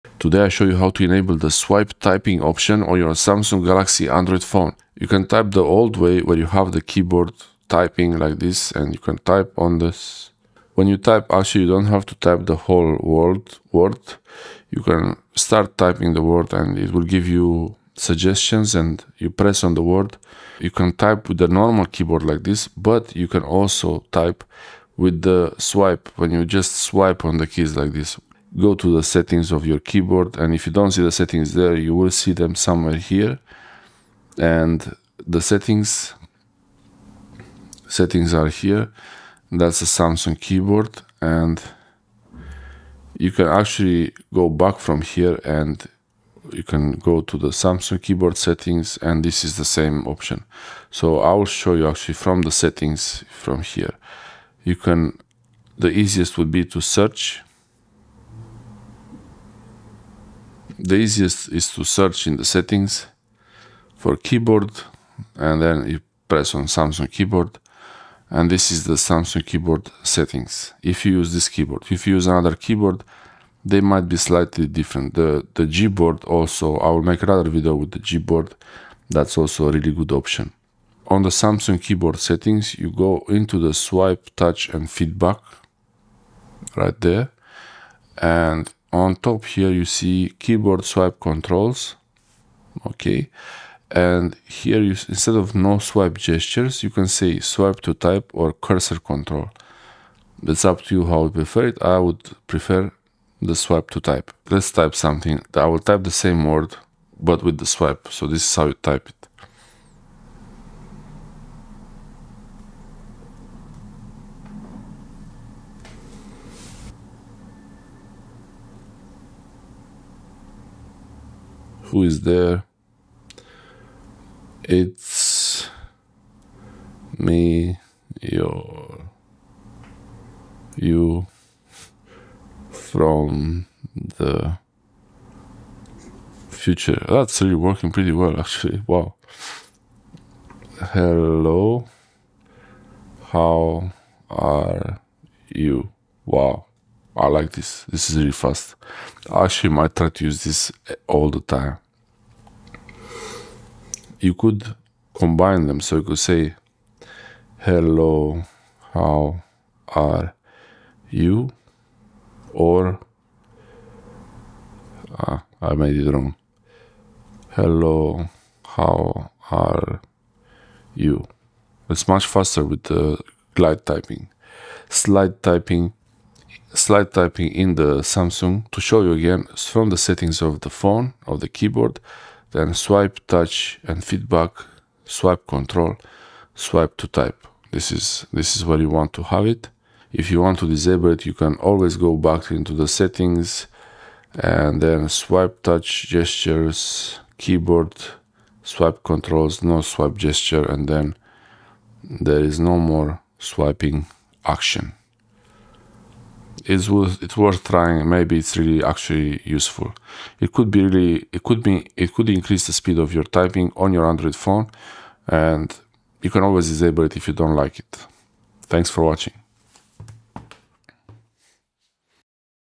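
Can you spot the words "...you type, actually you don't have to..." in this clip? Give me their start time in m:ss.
0:10.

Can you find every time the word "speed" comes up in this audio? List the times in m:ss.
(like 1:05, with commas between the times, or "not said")
3:32.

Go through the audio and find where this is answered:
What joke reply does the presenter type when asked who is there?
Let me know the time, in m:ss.
2:10.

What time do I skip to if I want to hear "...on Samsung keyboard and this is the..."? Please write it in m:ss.
1:06.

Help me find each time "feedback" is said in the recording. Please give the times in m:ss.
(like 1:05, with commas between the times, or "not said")
1:24, 3:04.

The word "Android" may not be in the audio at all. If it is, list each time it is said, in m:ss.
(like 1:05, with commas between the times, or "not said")
0:04, 3:34.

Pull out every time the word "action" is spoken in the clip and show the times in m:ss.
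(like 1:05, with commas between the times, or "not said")
3:24.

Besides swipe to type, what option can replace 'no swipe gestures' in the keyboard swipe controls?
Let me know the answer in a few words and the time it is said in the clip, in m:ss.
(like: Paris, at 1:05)
Cursor control, at 1:38.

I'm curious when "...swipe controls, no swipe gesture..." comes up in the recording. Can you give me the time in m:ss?
3:18.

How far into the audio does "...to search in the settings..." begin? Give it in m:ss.
1:01.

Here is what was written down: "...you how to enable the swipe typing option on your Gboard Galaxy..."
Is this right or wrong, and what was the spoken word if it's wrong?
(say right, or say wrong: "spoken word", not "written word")
wrong: "Samsung", not "Gboard".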